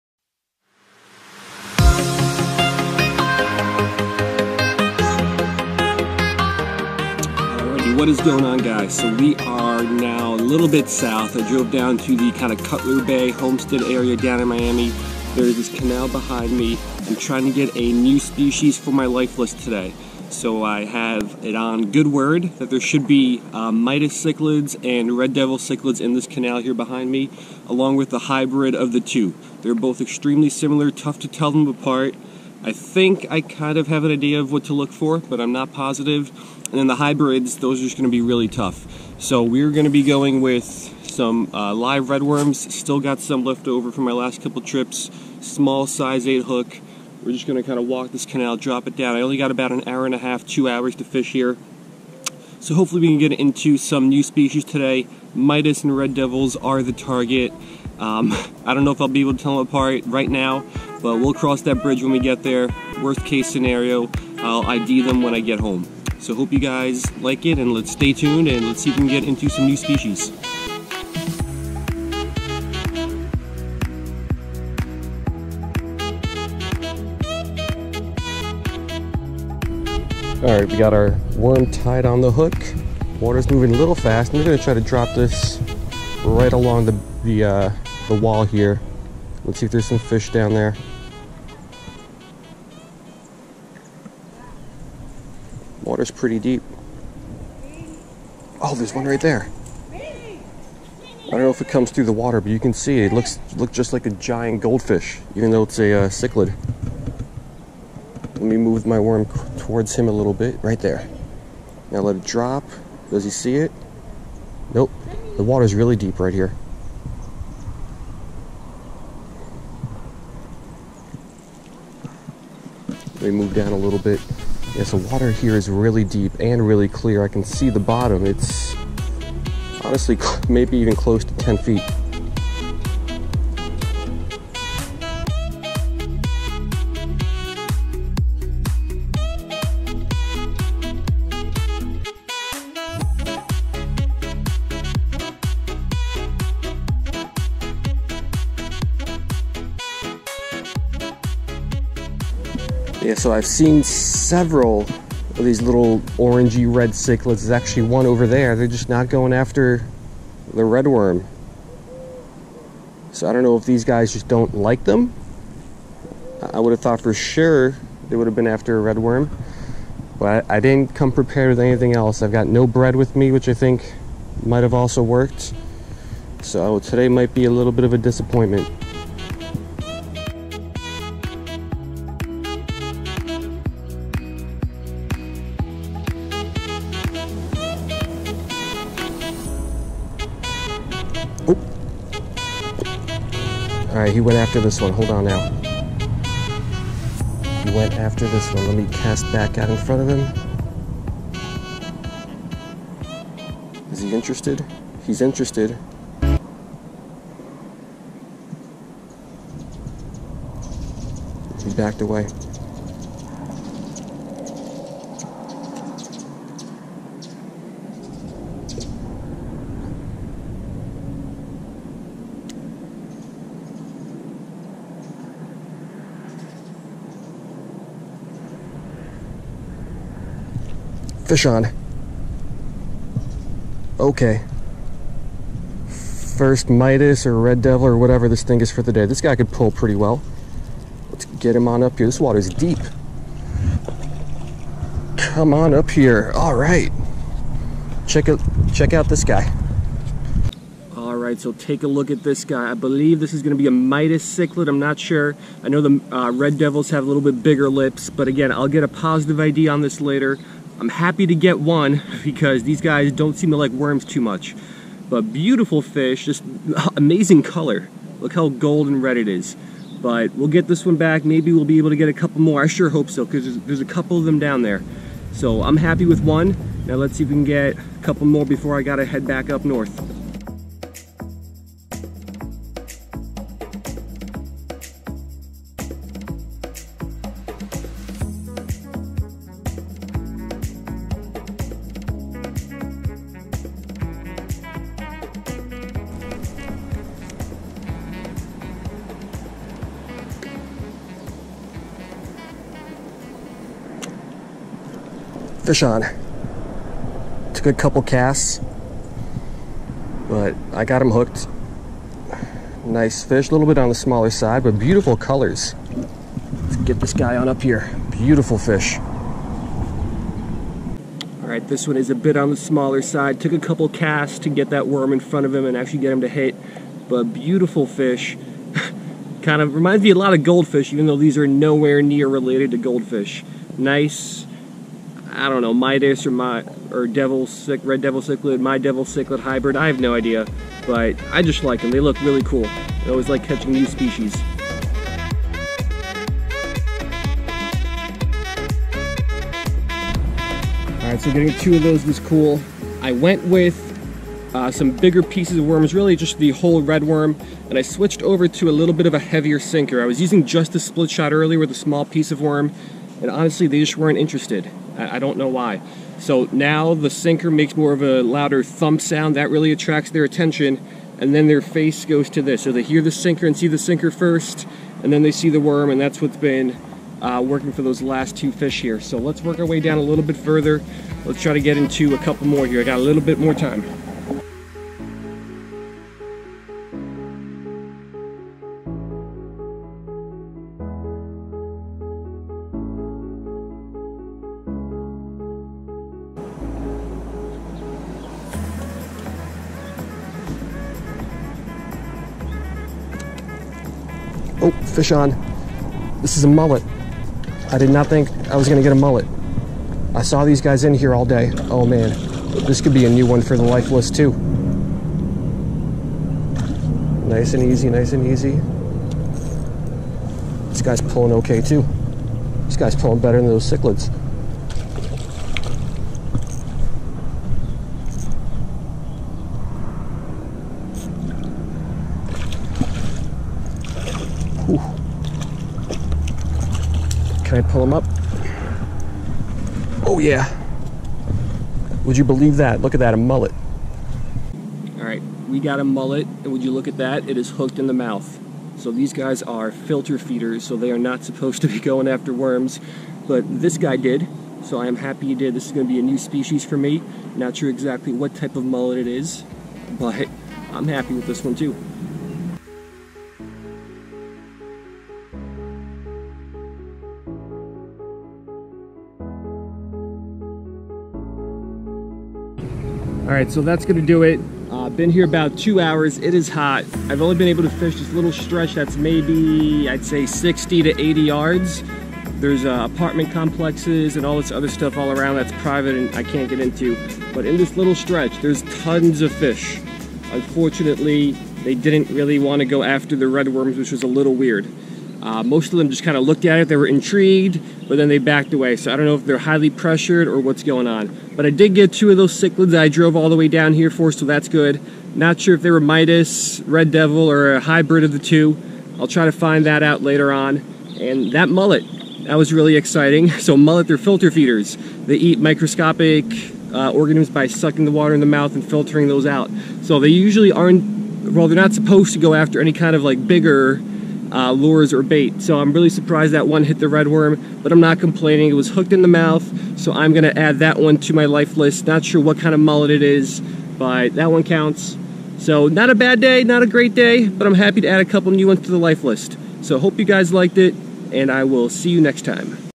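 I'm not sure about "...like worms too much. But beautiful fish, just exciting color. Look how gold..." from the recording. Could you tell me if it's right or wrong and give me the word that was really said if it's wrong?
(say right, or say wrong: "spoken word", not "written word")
wrong: "amazing", not "exciting".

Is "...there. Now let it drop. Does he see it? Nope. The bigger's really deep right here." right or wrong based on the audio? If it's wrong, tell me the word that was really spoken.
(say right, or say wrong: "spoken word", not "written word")
wrong: "water", not "bigger".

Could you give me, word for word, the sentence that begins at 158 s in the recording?
They're just not going after the red worm.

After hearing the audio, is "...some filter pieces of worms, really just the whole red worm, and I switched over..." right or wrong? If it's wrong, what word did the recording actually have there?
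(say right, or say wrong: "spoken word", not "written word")
wrong: "bigger", not "filter".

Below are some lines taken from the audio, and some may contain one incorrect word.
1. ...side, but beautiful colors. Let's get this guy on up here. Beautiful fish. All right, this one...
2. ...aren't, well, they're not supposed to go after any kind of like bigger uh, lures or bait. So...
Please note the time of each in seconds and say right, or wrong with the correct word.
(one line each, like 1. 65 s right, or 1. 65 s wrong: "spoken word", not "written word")
1. 314 s right
2. 520 s right.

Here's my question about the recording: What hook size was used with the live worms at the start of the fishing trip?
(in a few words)
8.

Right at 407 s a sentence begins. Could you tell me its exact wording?
I did not think I was gonna get a mullet.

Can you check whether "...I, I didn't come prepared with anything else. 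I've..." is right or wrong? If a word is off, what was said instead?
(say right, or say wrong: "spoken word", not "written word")
right.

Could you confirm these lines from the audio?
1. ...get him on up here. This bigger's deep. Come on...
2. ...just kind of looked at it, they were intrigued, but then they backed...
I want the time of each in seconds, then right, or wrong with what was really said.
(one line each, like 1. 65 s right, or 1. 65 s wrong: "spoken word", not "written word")
1. 241 s wrong: "water", not "bigger"
2. 495 s right.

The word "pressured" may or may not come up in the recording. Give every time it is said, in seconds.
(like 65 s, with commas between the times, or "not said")
499 s.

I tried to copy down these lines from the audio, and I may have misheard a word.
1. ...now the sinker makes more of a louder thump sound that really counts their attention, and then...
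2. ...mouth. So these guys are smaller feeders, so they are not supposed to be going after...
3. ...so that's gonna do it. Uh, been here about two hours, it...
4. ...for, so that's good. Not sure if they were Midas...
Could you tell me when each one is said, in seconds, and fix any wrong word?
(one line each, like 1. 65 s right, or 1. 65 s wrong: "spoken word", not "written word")
1. 366 s wrong: "attracts", not "counts"
2. 447 s wrong: "filter", not "smaller"
3. 473 s right
4. 503 s right.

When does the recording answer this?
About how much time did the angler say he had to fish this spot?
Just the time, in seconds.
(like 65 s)
49 s.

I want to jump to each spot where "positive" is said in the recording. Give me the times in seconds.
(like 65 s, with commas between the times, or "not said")
35 s, 258 s.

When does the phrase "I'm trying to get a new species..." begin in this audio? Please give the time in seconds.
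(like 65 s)
17 s.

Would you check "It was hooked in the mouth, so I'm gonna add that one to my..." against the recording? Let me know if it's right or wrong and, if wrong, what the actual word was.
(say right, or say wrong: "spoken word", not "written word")
right.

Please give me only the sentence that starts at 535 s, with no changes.
So not a bad day, not a great day, but I'm happy to add a couple new ones to the life list.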